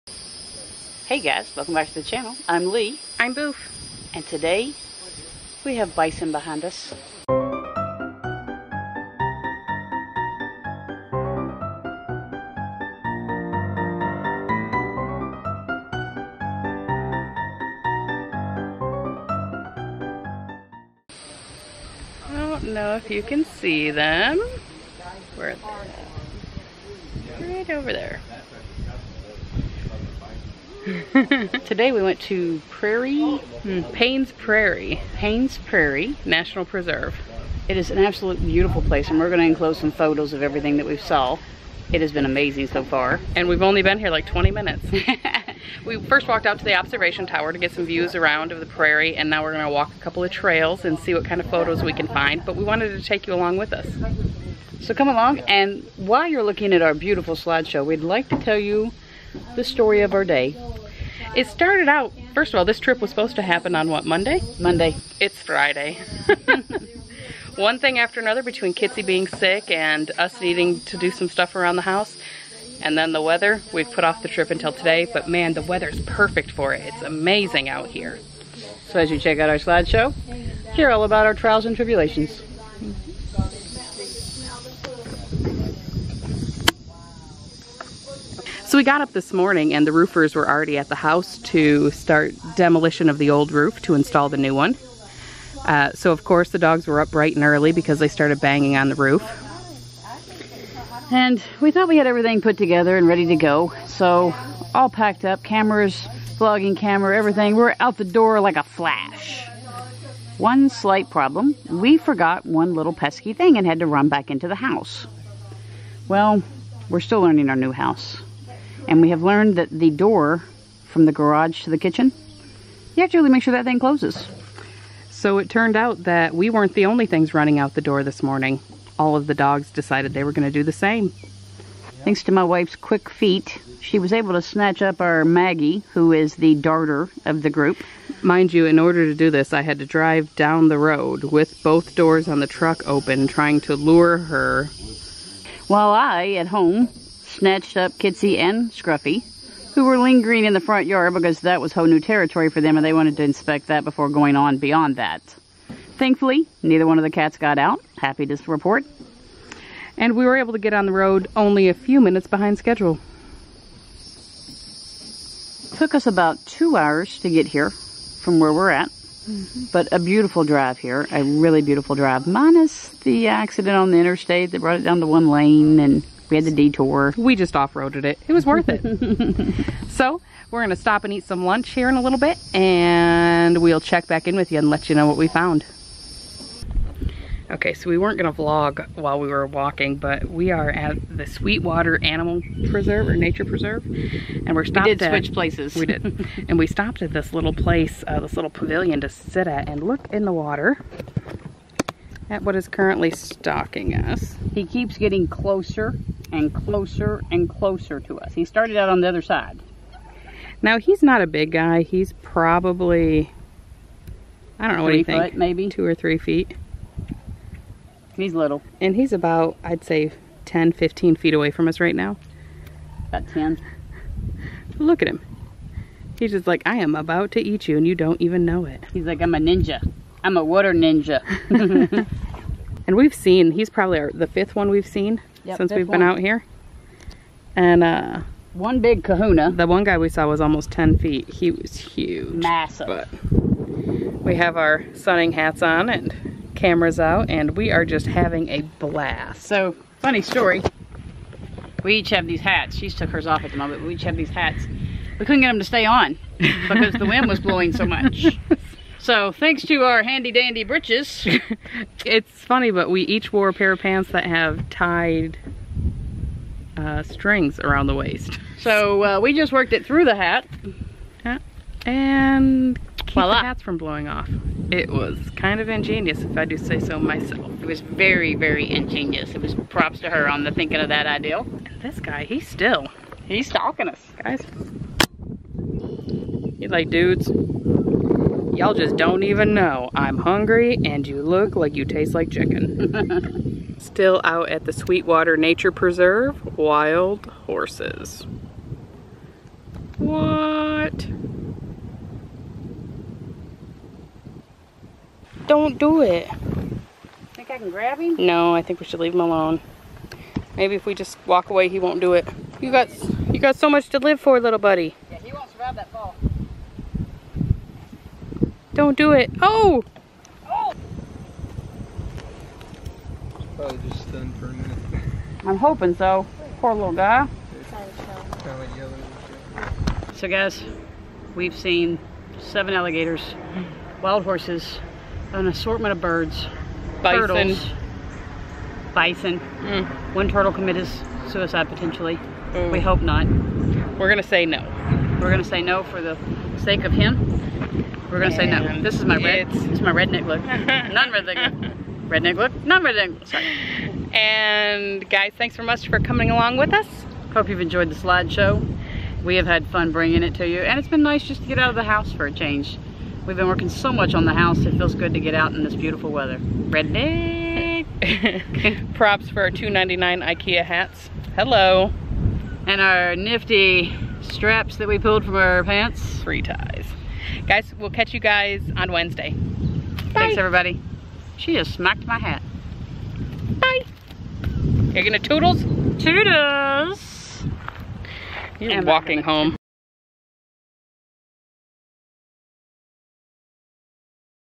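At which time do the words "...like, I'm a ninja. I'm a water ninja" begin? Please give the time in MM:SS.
03:49.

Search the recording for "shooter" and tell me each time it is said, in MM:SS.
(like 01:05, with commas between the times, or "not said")
not said.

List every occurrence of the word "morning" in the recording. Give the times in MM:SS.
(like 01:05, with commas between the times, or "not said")
01:29, 02:08.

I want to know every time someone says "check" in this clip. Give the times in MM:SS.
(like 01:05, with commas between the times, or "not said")
01:19, 03:03.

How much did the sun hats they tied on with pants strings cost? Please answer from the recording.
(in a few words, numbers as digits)
$2.99.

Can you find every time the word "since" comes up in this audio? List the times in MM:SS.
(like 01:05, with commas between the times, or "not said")
03:55.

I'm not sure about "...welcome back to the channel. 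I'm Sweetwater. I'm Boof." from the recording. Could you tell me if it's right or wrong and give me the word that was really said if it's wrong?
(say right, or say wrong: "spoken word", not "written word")
wrong: "Lee", not "Sweetwater".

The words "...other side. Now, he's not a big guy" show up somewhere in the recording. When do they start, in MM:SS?
03:29.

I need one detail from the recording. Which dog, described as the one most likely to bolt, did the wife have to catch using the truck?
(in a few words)
Maggie.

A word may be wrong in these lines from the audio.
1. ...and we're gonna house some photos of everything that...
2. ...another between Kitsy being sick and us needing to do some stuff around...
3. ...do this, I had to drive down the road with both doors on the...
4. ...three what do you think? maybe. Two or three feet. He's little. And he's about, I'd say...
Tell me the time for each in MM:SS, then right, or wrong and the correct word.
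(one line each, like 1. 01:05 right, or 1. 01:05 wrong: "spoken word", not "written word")
1. 00:39 wrong: "enclose", not "house"
2. 01:08 right
3. 02:19 right
4. 03:34 right.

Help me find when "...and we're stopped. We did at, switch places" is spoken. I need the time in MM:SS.
03:13.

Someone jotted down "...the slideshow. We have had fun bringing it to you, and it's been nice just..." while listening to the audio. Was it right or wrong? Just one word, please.
right.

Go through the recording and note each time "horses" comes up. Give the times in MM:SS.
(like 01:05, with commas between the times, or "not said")
04:57, 05:34.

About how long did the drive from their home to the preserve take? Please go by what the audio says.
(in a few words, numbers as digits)
2 hours.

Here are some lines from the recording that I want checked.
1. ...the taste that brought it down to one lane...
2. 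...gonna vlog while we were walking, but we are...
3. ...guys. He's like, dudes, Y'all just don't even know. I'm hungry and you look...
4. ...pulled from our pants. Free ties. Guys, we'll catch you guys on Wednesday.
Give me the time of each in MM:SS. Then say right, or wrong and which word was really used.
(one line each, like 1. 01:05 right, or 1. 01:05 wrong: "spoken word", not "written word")
1. 02:53 wrong: "interstate", not "taste"
2. 03:08 right
3. 04:44 right
4. 06:14 right.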